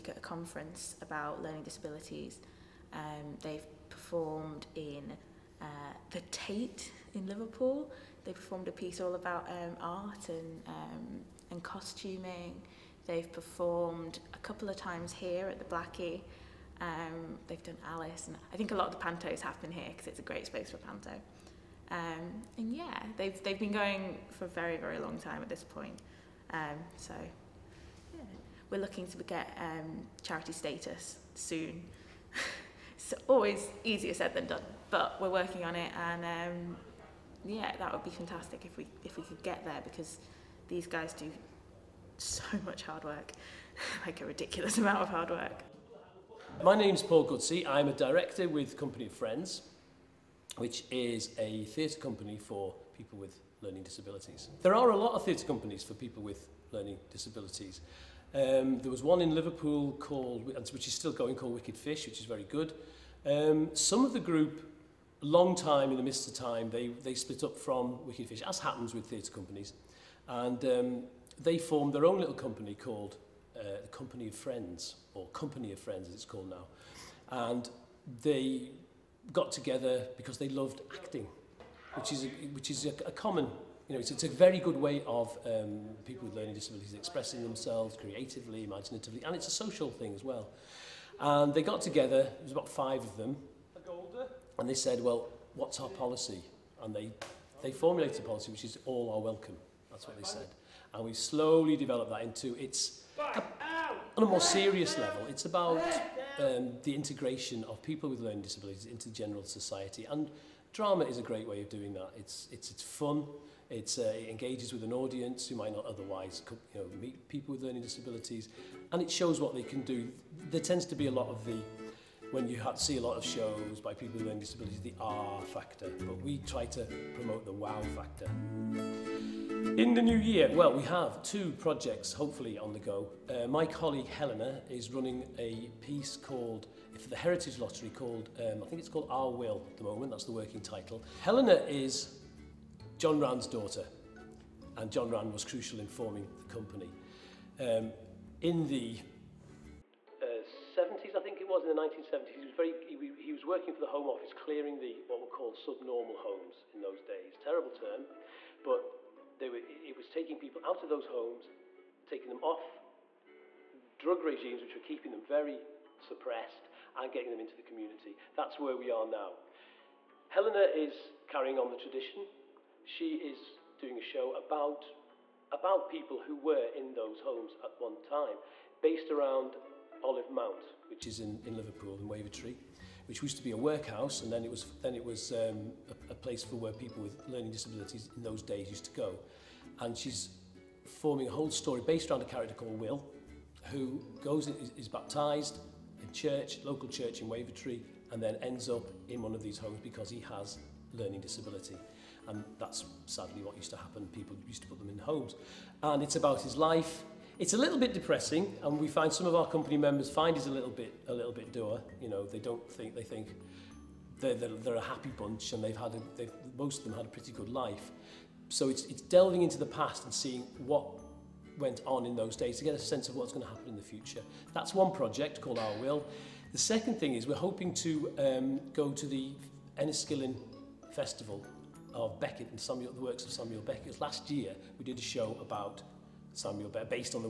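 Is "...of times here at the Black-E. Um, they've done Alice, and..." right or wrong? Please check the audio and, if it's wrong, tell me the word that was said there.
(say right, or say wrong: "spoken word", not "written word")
right.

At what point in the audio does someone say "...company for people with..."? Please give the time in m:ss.
0:51.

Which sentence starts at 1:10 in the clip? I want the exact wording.
And um, they formed their own little company called uh, the Company of Friends, or Company of Friends as it's called now.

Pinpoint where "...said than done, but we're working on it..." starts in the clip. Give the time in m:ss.
0:34.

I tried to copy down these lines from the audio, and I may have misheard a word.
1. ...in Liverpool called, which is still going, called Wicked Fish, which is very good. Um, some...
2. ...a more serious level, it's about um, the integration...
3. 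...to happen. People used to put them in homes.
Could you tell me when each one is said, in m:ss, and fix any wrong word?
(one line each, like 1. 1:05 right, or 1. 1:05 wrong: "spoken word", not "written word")
1. 0:59 right
2. 1:44 right
3. 3:23 right.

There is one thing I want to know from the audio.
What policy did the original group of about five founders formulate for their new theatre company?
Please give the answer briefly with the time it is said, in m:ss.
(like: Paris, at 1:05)
All are welcome, at 1:38.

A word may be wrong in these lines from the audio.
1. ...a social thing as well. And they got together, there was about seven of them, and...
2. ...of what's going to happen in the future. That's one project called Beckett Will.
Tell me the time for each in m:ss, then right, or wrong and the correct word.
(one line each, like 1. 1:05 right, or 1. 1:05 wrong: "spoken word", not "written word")
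1. 1:29 wrong: "five", not "seven"
2. 3:43 wrong: "Our", not "Beckett".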